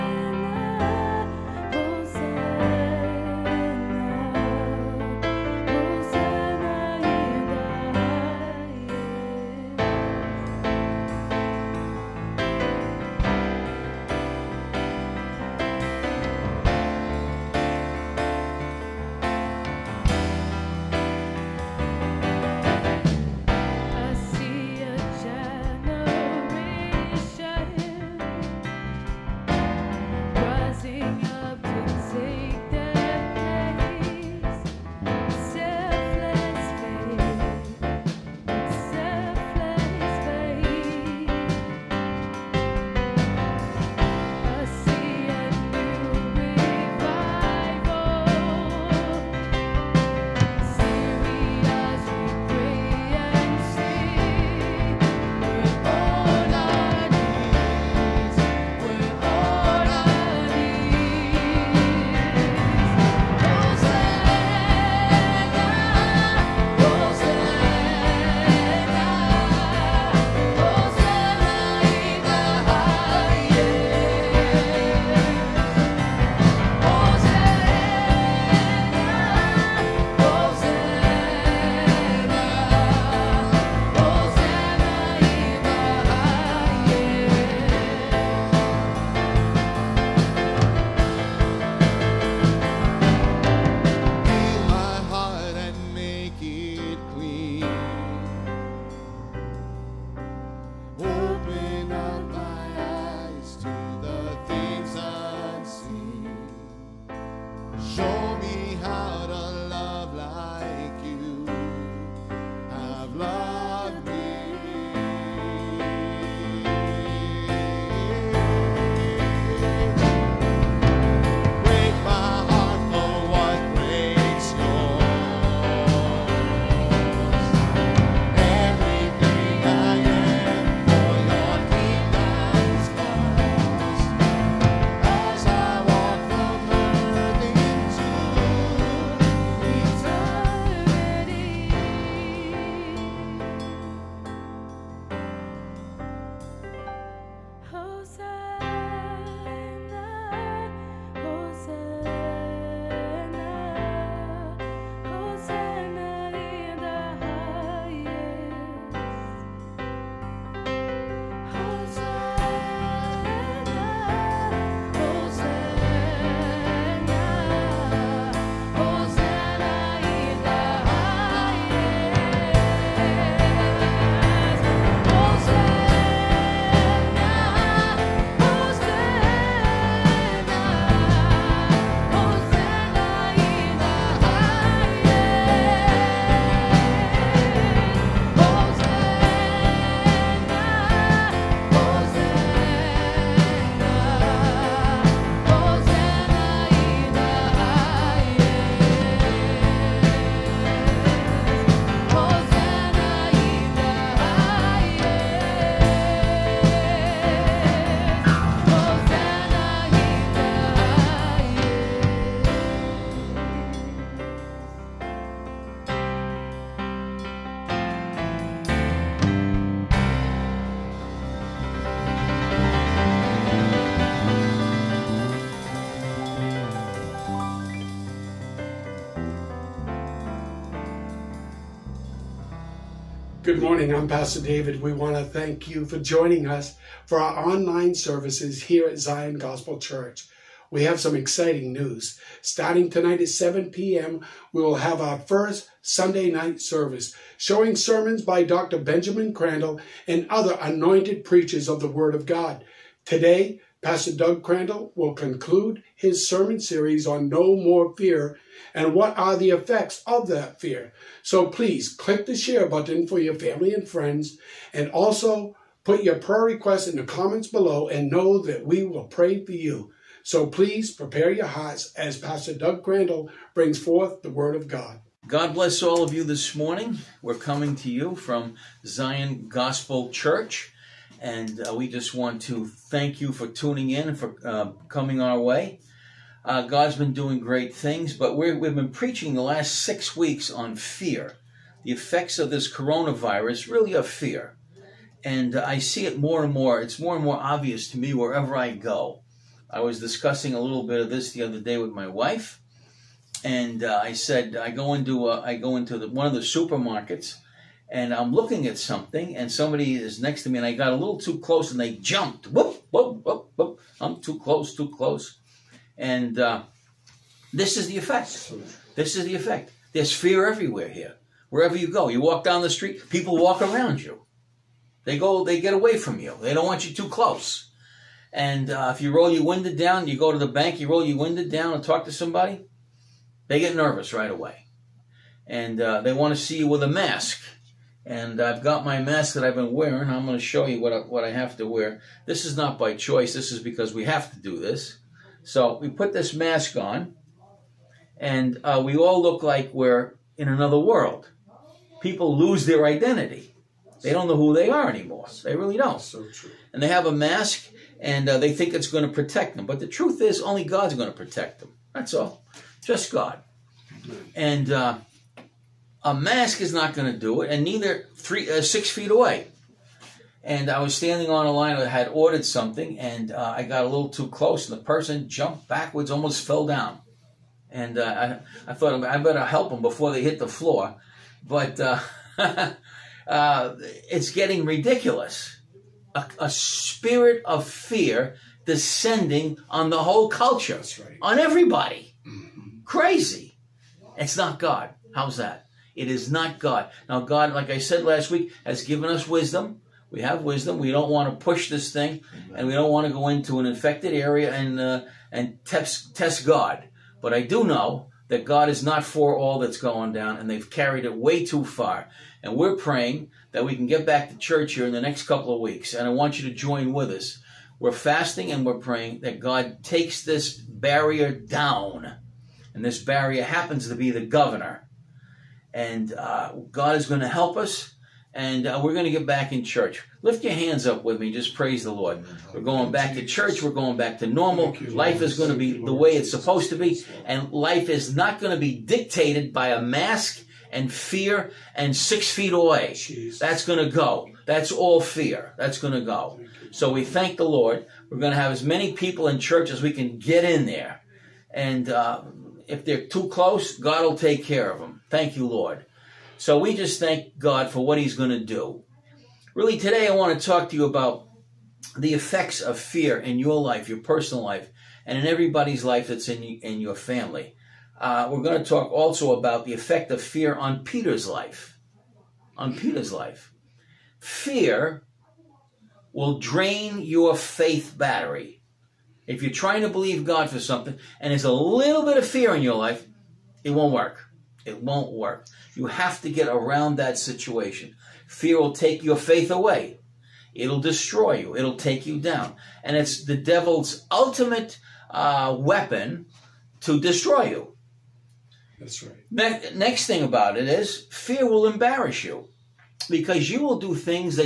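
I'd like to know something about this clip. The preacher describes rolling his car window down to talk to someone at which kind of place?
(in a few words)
The bank.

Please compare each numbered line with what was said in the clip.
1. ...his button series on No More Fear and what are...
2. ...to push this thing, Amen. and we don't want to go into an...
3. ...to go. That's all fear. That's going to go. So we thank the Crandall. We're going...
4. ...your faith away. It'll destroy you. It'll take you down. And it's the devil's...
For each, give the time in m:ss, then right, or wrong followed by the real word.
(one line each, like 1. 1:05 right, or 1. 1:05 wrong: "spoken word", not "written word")
1. 4:15 wrong: "sermon", not "button"
2. 6:41 right
3. 7:23 wrong: "Lord", not "Crandall"
4. 8:09 right.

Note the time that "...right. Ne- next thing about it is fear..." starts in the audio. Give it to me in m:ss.
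8:19.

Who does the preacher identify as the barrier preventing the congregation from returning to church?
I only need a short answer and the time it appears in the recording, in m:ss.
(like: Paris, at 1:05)
The governor, at 7:04.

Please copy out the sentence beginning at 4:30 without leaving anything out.
So please prepare your hearts as Pastor Doug Crandall brings forth the Word of God.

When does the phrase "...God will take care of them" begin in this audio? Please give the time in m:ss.
7:33.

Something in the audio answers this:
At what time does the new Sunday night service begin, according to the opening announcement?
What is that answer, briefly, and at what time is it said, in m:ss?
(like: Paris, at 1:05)
7 p.m., at 4:03.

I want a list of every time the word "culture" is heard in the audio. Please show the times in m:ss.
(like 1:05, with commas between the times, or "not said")
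6:30.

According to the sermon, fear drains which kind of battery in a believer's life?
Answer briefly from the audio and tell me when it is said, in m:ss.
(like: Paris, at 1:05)
Faith battery, at 7:57.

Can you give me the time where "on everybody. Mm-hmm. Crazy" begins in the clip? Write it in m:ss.
6:31.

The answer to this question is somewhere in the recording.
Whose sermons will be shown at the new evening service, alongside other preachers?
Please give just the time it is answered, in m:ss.
4:08.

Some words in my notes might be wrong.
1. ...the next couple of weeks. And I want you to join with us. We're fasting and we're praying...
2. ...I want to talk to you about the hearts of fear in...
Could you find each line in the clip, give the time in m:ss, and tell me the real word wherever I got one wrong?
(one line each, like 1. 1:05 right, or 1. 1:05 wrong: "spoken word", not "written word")
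1. 6:54 right
2. 7:40 wrong: "effects", not "hearts".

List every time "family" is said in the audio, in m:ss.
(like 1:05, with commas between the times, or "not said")
4:23, 7:46.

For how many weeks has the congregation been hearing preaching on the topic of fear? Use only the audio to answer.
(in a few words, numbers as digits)
6.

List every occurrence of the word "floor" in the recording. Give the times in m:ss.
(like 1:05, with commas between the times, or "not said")
6:20.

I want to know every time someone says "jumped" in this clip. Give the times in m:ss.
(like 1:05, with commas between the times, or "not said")
5:11, 6:15.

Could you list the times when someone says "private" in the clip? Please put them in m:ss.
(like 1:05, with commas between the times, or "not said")
not said.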